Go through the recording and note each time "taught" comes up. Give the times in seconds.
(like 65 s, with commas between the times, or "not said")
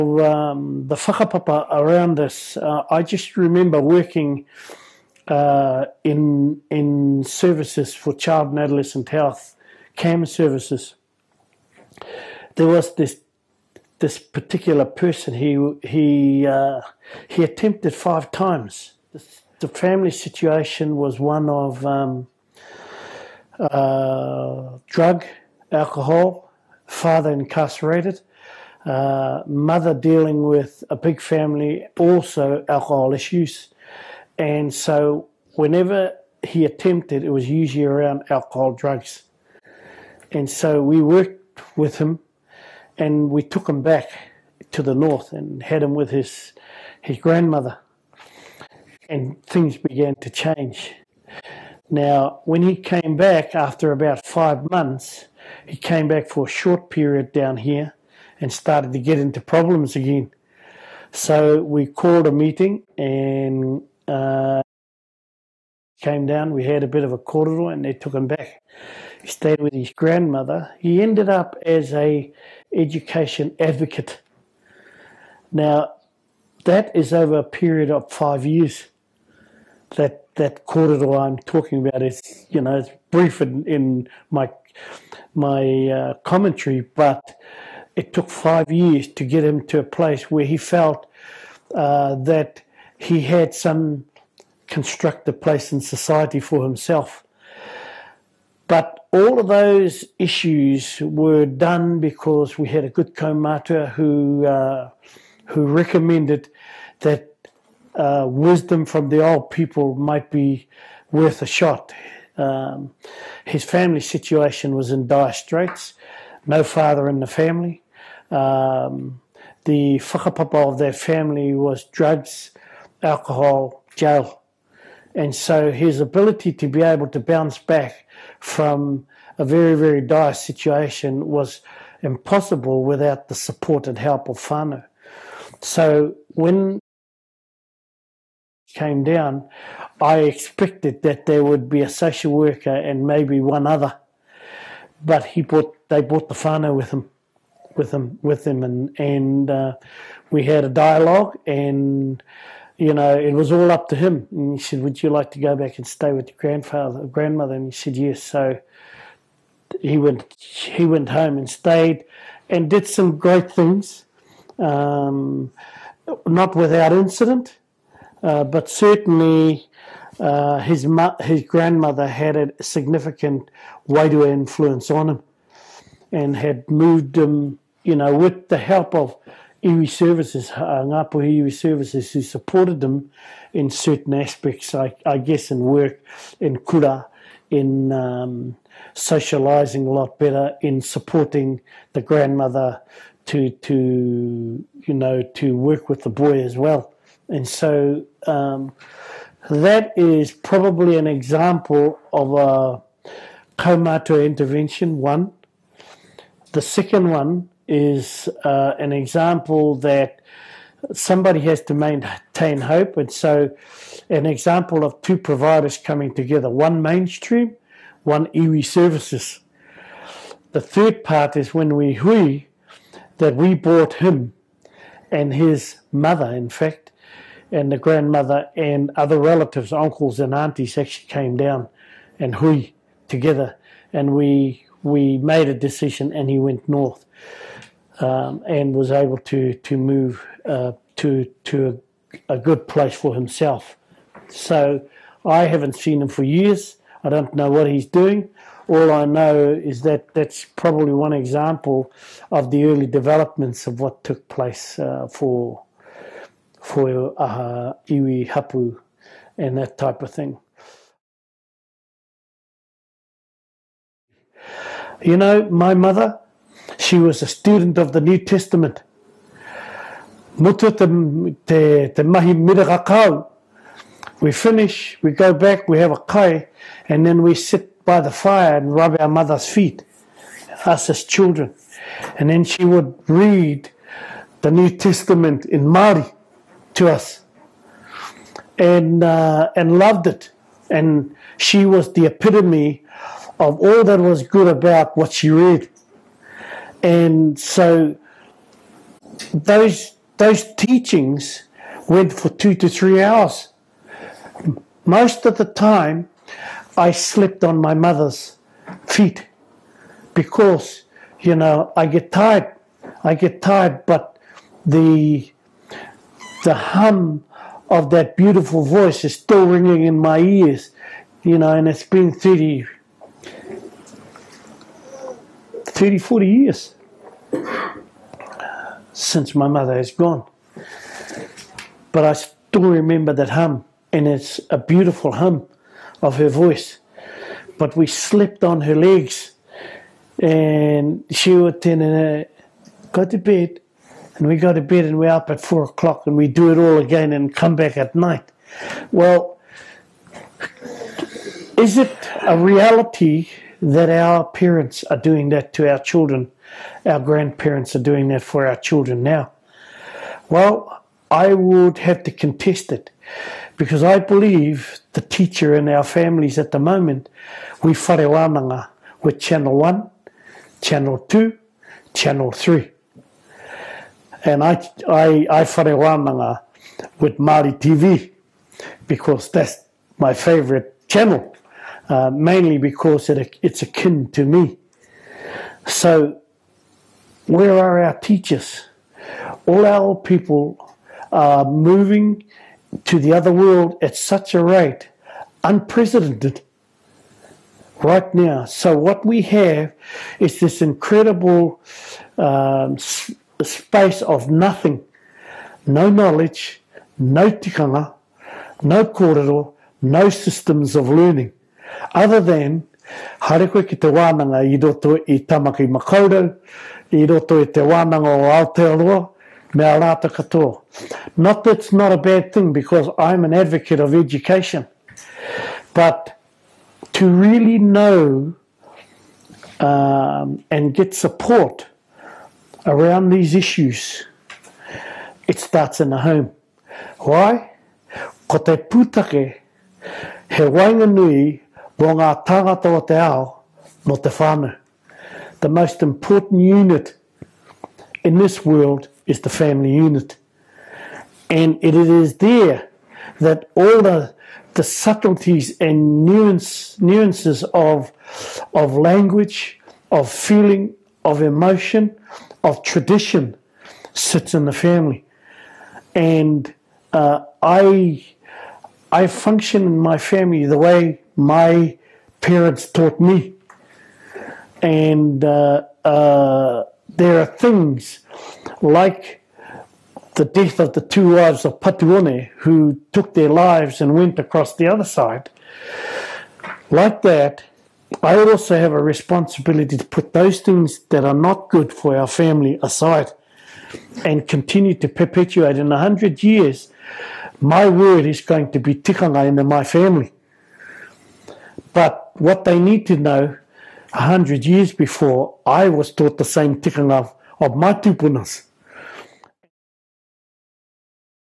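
472 s, 505 s.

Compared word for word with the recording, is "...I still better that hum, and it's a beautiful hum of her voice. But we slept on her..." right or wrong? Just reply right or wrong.
wrong.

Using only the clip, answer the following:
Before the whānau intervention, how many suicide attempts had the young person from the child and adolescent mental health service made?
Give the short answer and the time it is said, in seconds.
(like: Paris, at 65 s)
5, at 17 s.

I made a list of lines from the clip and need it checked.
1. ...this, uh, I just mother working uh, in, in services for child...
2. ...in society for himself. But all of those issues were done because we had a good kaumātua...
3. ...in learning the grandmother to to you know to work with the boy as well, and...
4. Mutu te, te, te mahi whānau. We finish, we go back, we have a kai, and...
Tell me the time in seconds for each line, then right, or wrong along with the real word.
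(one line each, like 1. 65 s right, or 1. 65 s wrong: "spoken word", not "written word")
1. 2 s wrong: "remember", not "mother"
2. 95 s right
3. 190 s wrong: "supporting", not "learning"
4. 270 s wrong: "mirakakau", not "whānau".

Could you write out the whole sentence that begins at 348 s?
Well, is it a reality that our parents are doing that to our children?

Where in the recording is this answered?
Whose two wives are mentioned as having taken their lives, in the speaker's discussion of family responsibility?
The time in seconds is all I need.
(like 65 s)
481 s.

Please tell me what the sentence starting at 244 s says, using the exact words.
So I haven't seen him for years.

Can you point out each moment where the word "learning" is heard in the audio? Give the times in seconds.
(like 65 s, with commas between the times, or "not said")
410 s.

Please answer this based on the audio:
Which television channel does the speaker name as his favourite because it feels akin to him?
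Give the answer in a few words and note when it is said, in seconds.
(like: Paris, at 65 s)
Māori TV, at 377 s.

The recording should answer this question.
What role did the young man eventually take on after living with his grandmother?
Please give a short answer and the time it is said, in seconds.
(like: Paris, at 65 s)
Education advocate, at 72 s.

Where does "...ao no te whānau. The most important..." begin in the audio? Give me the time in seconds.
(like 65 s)
442 s.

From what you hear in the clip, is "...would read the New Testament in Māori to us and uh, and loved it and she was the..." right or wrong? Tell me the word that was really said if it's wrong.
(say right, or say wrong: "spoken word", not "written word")
right.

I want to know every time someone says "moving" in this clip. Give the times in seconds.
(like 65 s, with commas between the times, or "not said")
391 s.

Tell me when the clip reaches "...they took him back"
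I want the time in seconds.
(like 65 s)
67 s.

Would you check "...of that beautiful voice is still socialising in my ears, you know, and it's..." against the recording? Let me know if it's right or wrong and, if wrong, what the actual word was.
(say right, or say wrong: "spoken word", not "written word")
wrong: "ringing", not "socialising".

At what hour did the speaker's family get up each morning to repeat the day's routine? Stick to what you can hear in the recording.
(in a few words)
4 o'clock.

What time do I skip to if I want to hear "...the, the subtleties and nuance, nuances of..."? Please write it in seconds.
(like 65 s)
453 s.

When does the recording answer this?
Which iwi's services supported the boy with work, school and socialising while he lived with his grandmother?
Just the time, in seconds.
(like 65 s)
180 s.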